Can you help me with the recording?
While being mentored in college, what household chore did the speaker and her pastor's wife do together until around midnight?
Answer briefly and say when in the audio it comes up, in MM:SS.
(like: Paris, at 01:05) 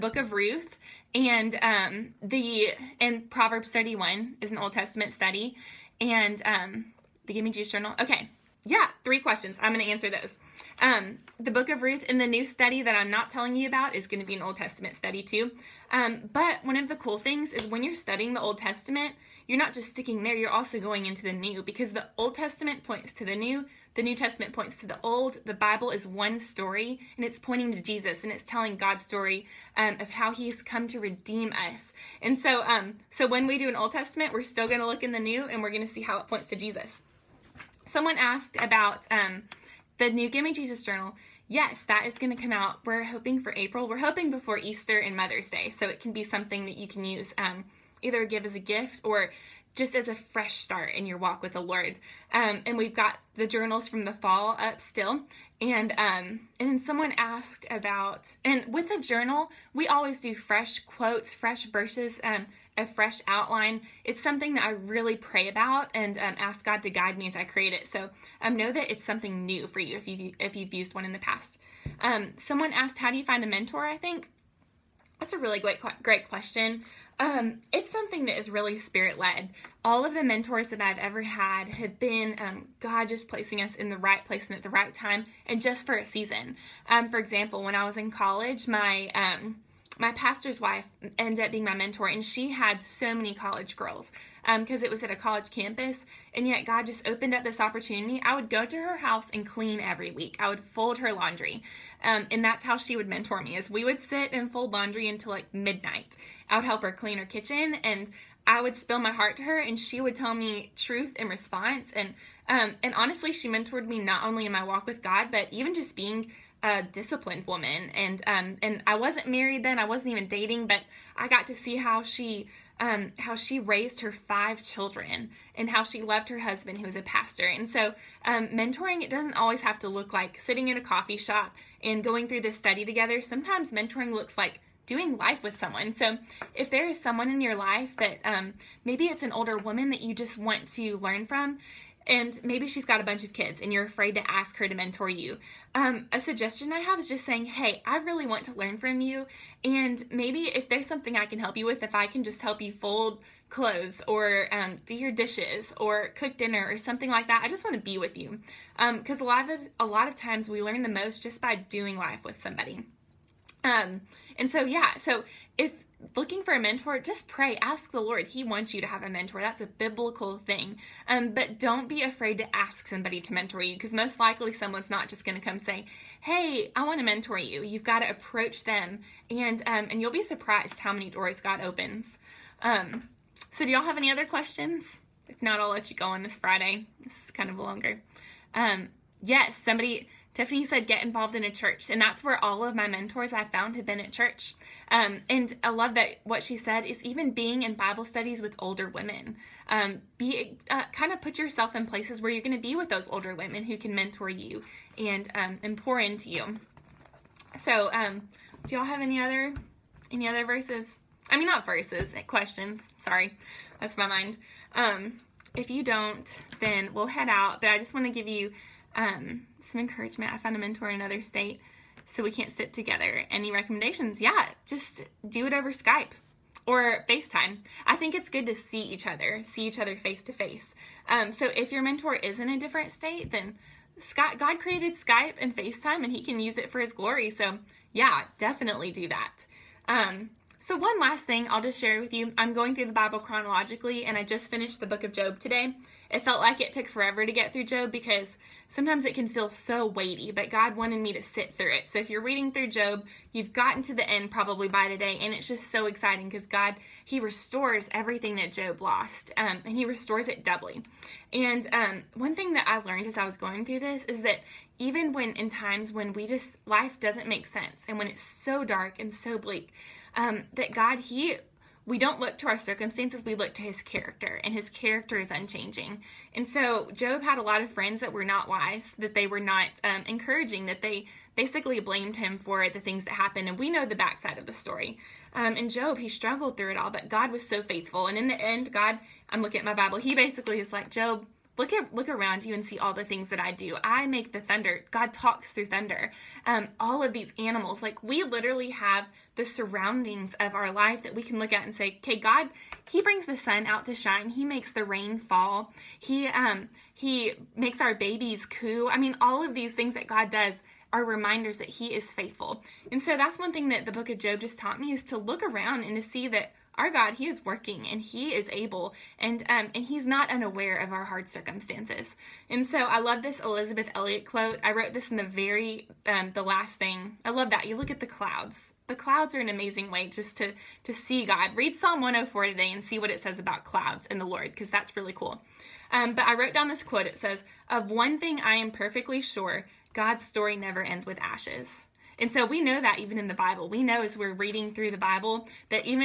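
Fold laundry, at 01:44.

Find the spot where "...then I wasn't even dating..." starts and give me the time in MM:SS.
01:59.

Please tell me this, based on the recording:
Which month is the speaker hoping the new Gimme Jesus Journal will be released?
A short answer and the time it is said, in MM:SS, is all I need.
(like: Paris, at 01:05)
April, at 00:43.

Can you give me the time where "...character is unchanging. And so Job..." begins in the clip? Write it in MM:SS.
04:34.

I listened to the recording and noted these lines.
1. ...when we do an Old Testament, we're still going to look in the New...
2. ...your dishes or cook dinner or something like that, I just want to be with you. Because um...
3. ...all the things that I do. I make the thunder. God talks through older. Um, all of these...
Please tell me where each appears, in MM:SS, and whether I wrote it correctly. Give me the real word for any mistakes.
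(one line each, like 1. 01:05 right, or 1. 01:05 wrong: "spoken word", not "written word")
1. 00:33 right
2. 02:34 right
3. 04:52 wrong: "thunder", not "older".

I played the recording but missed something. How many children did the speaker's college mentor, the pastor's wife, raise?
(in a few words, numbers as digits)
5.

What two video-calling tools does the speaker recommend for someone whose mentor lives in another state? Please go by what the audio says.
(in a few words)
Skype or FaceTime.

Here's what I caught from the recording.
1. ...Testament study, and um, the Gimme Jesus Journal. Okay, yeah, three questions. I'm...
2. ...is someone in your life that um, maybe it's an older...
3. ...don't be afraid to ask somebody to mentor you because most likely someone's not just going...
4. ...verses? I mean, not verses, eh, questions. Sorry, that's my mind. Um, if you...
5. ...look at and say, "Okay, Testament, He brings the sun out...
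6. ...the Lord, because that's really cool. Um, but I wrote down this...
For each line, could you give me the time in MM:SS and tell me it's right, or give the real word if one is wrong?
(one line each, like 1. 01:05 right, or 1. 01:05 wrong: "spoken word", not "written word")
1. 00:04 right
2. 02:16 right
3. 02:51 right
4. 03:30 right
5. 05:01 wrong: "God", not "Testament"
6. 05:34 right.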